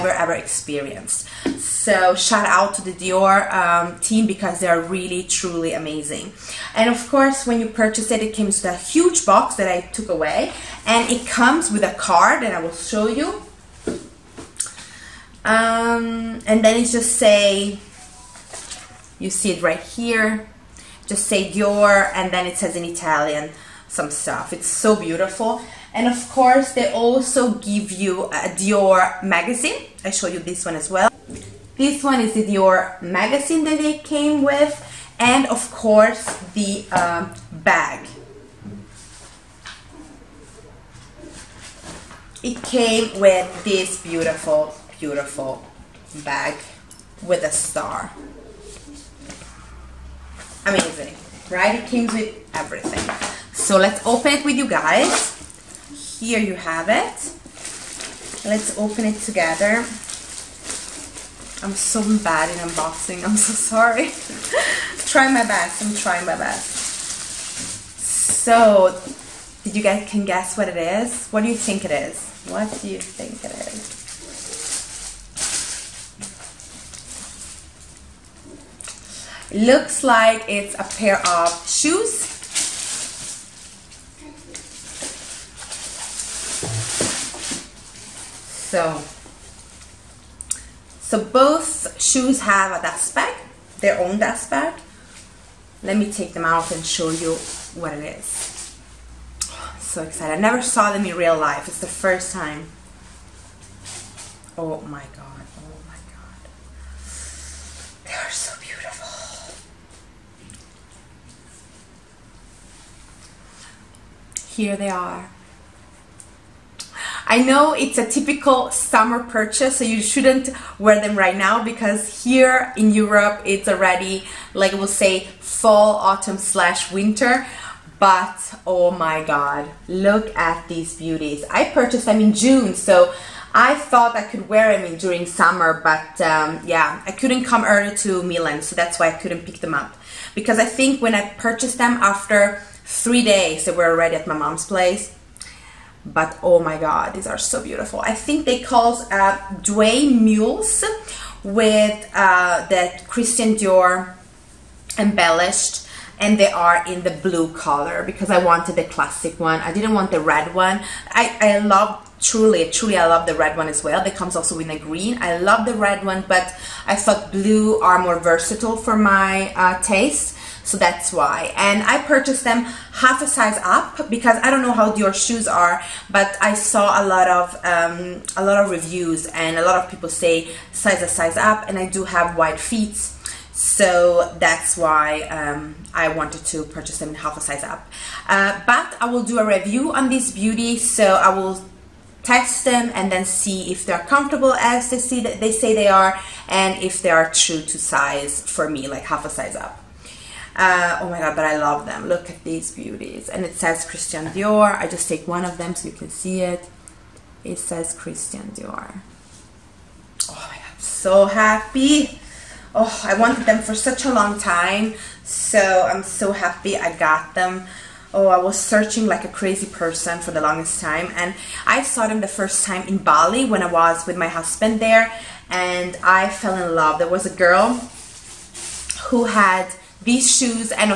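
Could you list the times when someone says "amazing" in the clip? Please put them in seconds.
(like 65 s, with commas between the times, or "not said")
5 s, 50 s.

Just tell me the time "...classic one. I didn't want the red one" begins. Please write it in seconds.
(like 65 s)
158 s.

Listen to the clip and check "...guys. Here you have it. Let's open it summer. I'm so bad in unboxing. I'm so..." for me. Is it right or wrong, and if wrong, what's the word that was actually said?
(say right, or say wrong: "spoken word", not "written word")
wrong: "together", not "summer".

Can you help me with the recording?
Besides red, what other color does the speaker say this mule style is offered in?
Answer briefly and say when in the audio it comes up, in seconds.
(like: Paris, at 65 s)
Green, at 164 s.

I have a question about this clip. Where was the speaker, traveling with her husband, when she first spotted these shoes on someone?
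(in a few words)
Bali.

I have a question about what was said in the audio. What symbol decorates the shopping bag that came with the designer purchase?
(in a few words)
A star.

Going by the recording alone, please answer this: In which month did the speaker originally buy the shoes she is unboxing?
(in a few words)
June.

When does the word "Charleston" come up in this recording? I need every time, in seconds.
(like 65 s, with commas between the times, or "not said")
not said.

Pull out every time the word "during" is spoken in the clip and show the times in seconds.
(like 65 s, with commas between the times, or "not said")
134 s.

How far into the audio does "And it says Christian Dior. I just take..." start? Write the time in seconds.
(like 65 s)
203 s.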